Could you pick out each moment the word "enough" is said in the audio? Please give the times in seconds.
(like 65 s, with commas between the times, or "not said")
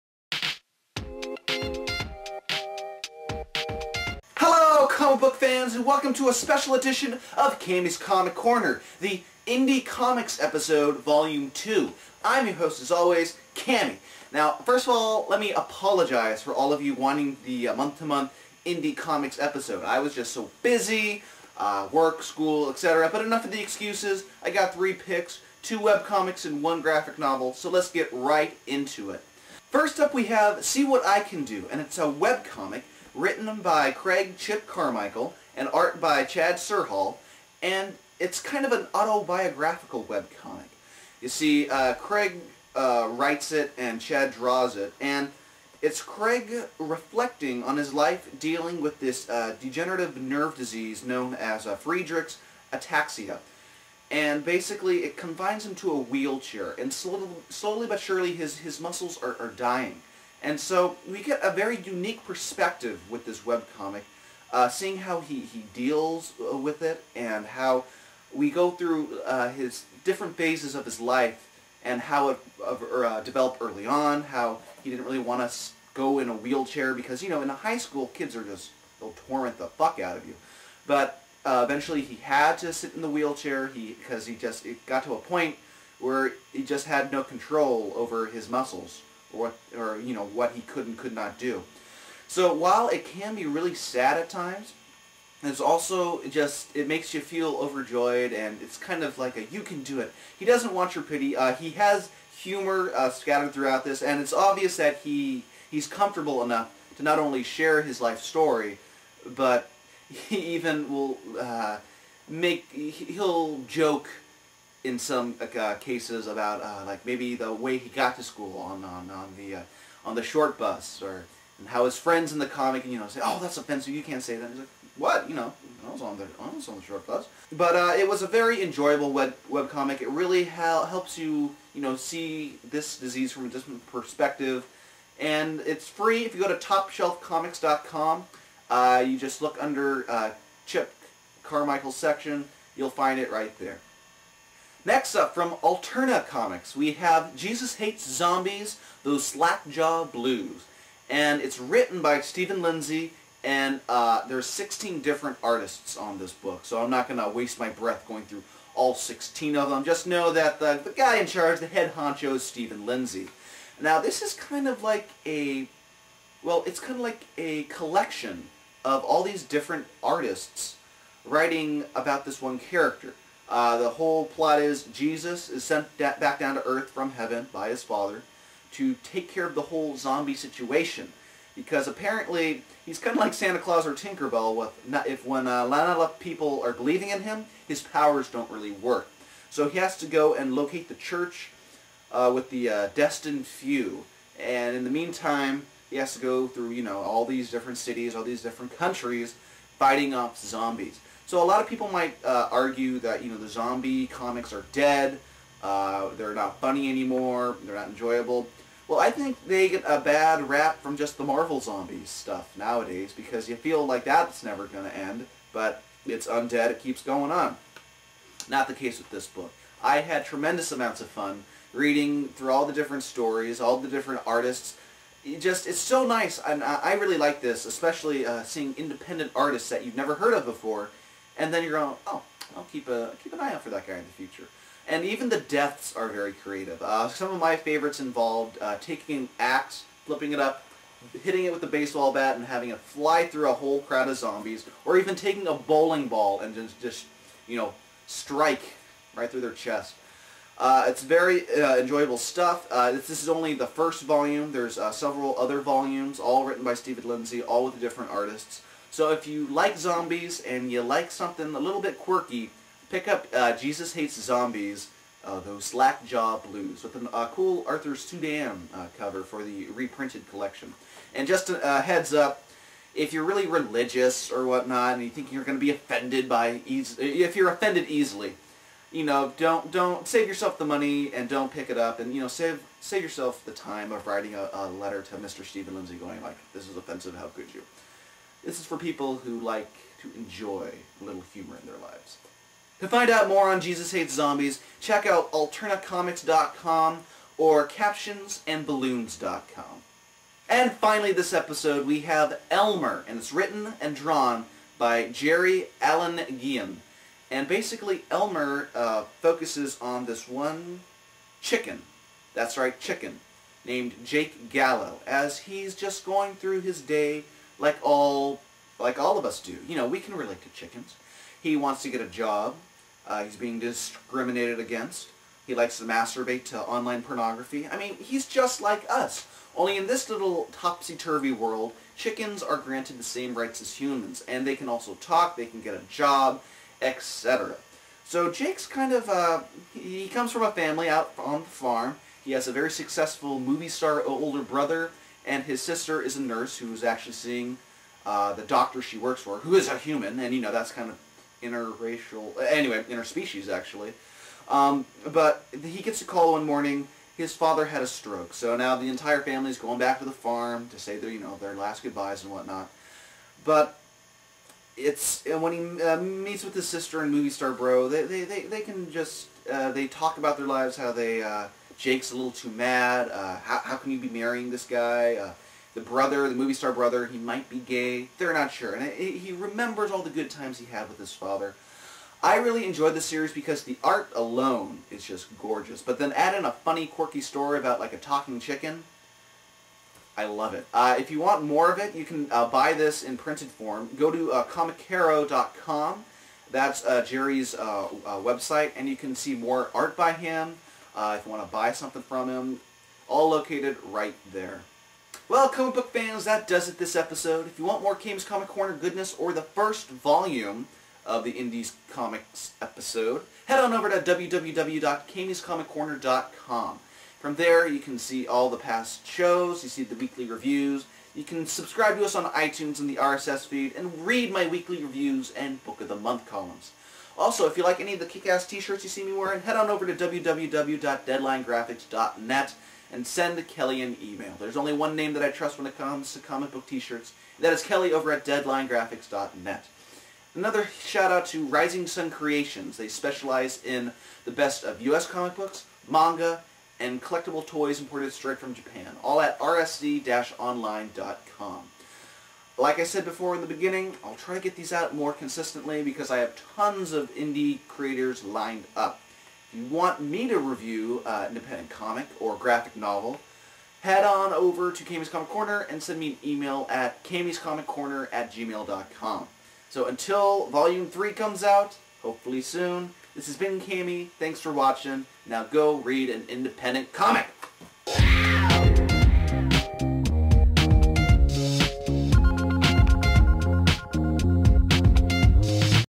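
23 s, 106 s, 185 s.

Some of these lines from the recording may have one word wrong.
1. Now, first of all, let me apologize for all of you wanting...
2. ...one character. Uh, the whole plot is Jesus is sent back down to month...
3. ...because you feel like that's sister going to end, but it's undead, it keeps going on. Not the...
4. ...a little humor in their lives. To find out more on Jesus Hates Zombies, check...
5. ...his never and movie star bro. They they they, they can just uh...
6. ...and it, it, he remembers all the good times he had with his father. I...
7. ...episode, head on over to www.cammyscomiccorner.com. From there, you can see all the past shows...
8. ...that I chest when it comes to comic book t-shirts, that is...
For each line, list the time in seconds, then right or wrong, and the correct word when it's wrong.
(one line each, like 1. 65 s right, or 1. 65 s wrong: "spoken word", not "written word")
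1. 14 s right
2. 172 s wrong: "earth", not "month"
3. 213 s wrong: "never", not "sister"
4. 290 s right
5. 366 s wrong: "sister", not "never"
6. 378 s right
7. 412 s right
8. 435 s wrong: "trust", not "chest".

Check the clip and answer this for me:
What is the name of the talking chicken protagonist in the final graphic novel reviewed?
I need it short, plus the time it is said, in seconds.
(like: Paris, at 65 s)
Jake Gallo, at 314 s.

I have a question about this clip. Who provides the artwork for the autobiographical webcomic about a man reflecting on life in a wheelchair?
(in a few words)
Chad Serhall.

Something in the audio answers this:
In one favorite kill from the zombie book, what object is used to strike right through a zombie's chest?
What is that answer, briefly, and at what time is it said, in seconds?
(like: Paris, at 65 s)
a bowling ball, at 245 s.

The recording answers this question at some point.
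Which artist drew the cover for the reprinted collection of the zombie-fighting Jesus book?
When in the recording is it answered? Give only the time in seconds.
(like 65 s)
267 s.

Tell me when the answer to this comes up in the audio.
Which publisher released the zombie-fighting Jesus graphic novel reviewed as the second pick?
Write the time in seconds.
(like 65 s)
145 s.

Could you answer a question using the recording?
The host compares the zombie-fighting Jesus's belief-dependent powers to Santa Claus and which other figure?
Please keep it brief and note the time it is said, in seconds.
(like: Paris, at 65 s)
Tinkerbell, at 183 s.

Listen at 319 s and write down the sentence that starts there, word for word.
You know, we can relate to chickens.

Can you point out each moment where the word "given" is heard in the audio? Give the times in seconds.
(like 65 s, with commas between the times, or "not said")
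not said.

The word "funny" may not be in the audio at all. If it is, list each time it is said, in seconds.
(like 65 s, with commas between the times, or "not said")
206 s, 386 s.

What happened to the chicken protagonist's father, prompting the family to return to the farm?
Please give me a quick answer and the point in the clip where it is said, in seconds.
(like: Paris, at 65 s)
a stroke, at 357 s.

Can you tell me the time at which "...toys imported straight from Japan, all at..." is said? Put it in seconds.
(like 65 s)
447 s.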